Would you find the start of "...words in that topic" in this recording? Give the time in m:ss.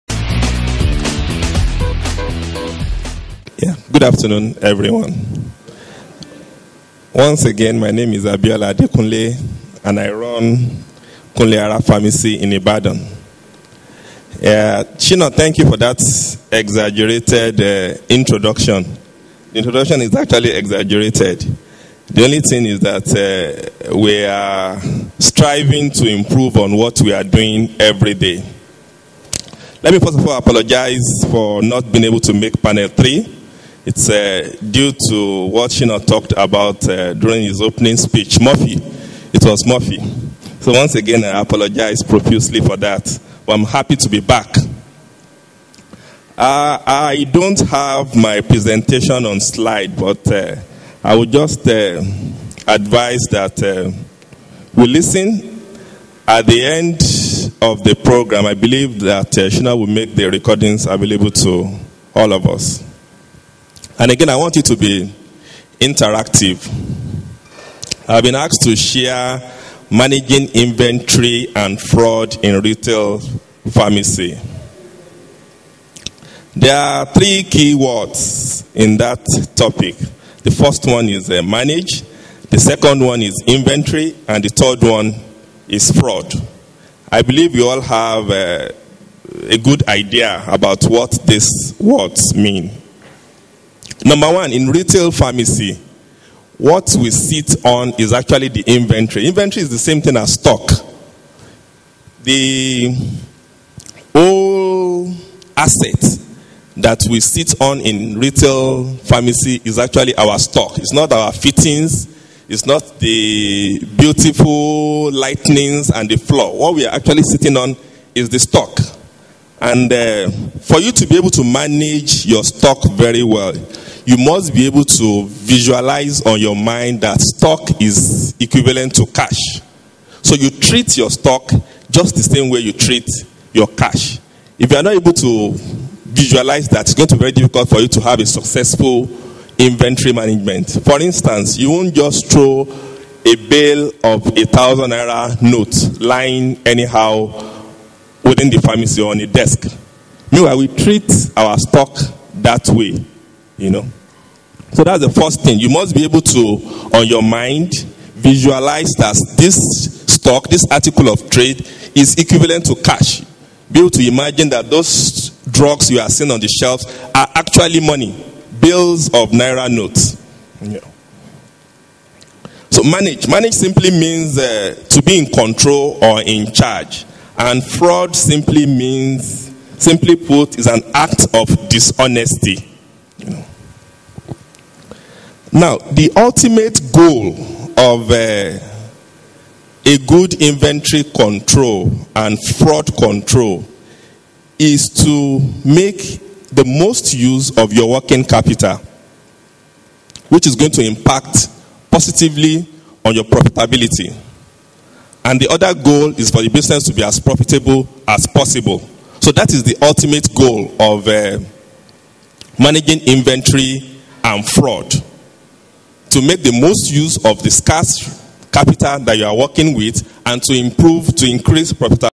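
1:17.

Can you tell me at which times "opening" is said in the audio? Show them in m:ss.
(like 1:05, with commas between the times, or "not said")
0:37.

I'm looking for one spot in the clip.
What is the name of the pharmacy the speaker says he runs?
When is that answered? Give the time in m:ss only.
0:11.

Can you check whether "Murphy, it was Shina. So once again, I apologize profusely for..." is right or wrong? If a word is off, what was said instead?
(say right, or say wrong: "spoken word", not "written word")
wrong: "Murphy", not "Shina".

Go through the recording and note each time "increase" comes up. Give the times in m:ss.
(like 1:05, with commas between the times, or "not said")
3:41.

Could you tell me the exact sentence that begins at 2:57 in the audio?
And fraud simply means, simply put, is an act of dishonesty.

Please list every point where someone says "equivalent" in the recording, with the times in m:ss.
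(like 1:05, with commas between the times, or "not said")
2:08, 2:42.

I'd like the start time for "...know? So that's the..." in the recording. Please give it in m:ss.
2:33.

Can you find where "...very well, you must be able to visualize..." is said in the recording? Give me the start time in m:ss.
2:02.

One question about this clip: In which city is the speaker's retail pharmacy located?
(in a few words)
Ibadan.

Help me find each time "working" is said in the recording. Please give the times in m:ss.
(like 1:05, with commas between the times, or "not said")
3:17, 3:39.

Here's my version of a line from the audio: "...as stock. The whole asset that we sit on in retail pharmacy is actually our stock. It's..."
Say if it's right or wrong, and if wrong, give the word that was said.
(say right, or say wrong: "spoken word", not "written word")
right.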